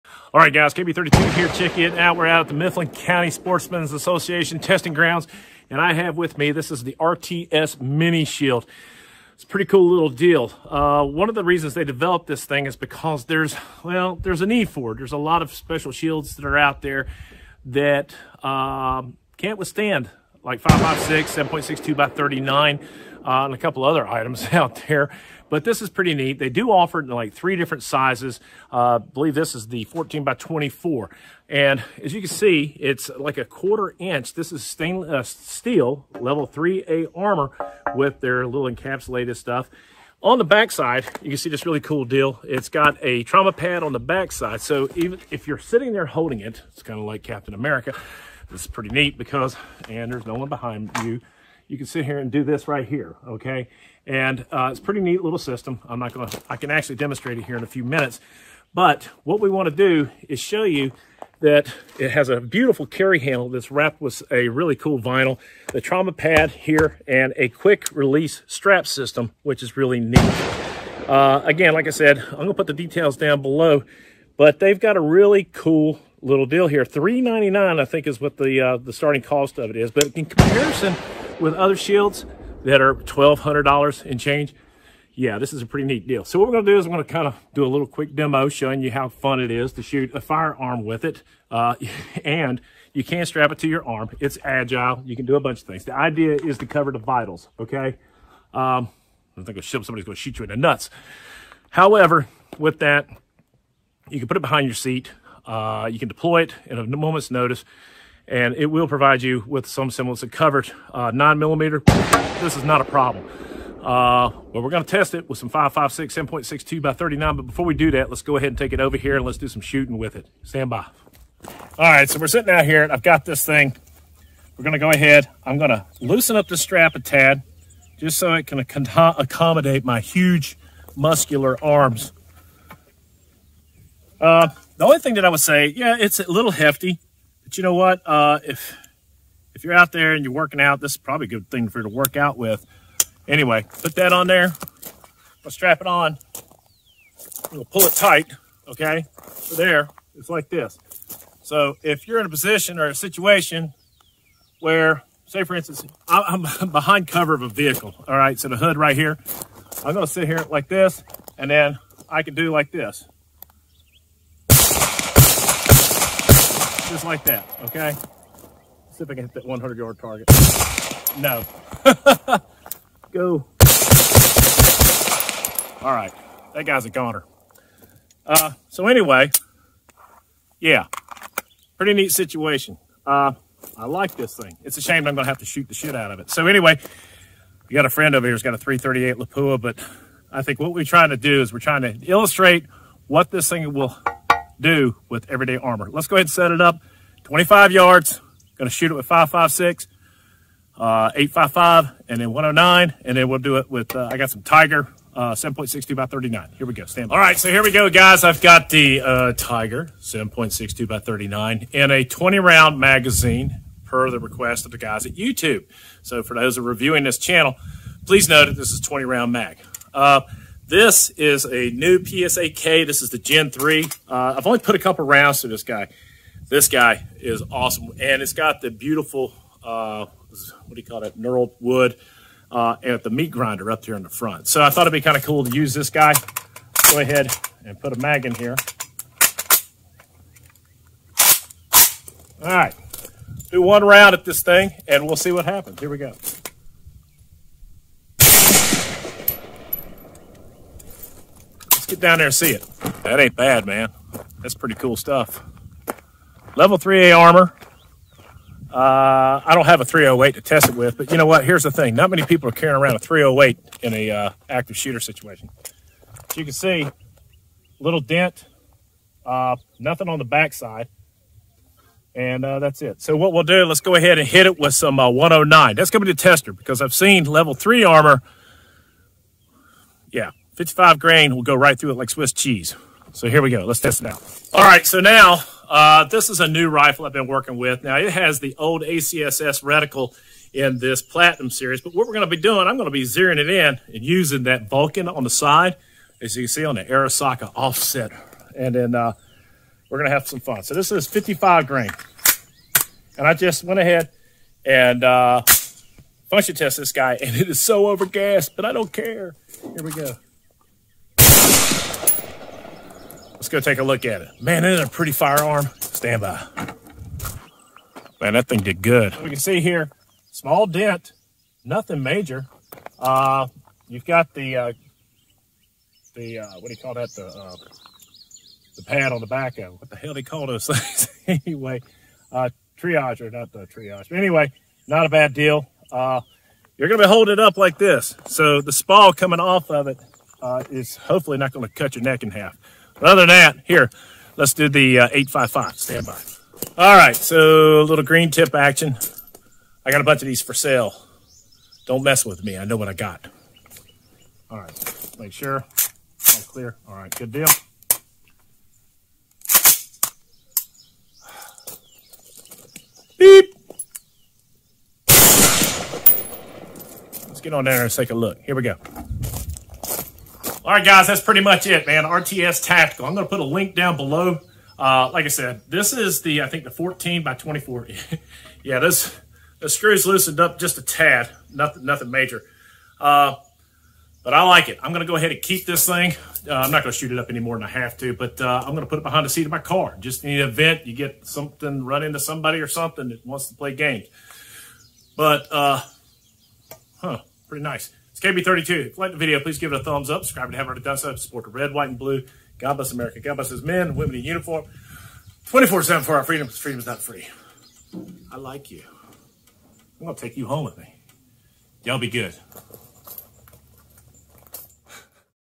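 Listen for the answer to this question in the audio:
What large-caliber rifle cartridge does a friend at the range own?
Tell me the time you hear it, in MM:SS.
03:08.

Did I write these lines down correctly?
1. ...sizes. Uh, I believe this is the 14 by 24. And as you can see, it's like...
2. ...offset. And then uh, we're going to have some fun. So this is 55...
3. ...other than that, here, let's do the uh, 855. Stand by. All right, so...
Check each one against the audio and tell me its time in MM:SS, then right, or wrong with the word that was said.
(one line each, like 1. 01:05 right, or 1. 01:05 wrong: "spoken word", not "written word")
1. 00:27 right
2. 04:57 right
3. 05:43 right.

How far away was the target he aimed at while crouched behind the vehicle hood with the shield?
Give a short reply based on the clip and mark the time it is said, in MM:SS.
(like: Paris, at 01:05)
100 yards, at 02:49.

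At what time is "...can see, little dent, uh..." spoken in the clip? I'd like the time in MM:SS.
04:26.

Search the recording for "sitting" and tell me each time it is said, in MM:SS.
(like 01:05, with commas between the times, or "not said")
00:45, 02:02.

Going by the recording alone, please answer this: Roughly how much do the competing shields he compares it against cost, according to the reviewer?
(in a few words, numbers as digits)
$1,200.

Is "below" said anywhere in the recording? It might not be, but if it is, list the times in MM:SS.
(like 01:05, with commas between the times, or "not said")
01:13, 06:13.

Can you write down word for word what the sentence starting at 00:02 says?
We're out at the Mifflin County Sportsmen's Association testing grounds, and I have with me, this is the RTS Mini Shield.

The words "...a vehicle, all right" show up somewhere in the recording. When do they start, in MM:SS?
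02:37.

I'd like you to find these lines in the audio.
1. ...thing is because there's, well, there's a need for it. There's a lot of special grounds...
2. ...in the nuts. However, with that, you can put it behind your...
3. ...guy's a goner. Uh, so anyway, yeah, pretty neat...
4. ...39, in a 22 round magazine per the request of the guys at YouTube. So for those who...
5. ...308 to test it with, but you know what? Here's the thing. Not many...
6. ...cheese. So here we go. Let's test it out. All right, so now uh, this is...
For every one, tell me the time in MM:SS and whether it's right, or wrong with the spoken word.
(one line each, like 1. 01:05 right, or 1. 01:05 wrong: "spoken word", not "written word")
1. 00:12 wrong: "shields", not "grounds"
2. 01:40 right
3. 02:56 right
4. 03:30 wrong: "20", not "22"
5. 04:19 right
6. 04:42 right.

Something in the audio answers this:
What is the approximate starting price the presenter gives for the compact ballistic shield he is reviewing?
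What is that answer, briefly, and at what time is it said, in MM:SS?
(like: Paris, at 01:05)
$399, at 01:16.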